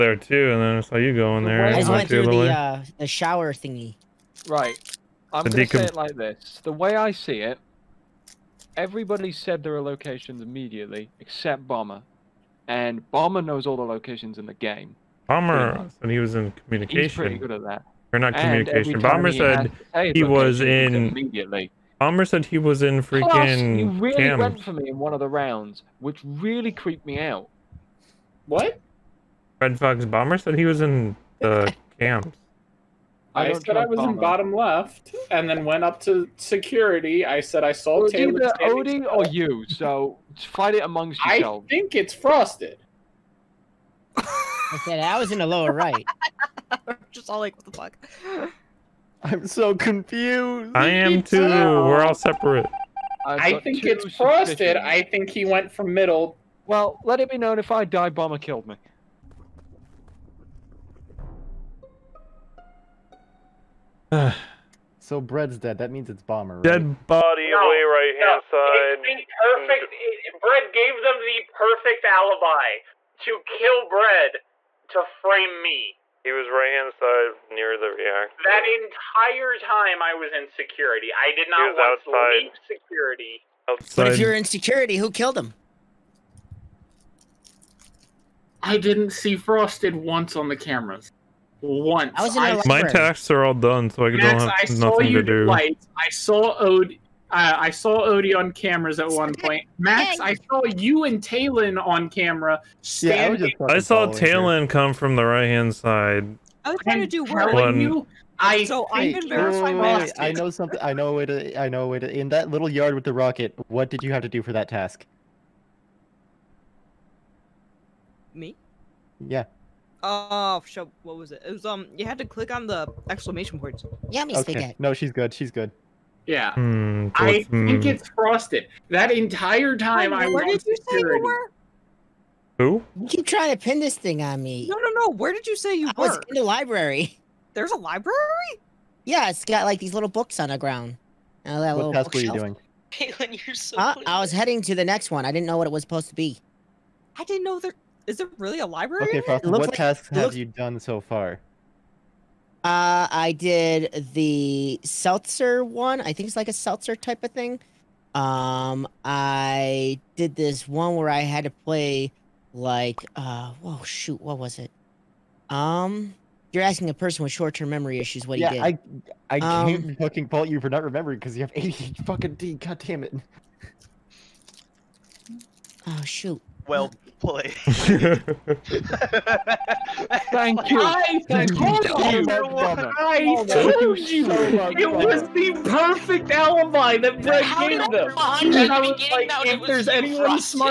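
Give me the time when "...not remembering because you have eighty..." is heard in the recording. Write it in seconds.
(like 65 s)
170 s.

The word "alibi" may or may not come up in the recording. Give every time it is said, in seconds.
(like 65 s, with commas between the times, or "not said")
72 s, 186 s.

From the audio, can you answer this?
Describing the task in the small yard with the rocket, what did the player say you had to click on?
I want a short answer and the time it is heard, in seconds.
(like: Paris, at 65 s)
Exclamation points, at 122 s.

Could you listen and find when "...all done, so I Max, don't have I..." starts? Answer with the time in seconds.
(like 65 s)
93 s.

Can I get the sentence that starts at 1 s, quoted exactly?
I just went through the, uh, the shower thingy.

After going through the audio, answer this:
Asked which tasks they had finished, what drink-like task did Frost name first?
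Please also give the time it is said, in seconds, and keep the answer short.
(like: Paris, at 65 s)
The seltzer one, at 154 s.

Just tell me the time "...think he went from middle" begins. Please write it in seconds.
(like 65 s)
55 s.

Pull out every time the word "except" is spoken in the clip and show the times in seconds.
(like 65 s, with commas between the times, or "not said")
11 s.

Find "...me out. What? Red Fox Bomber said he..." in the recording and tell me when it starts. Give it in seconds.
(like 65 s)
27 s.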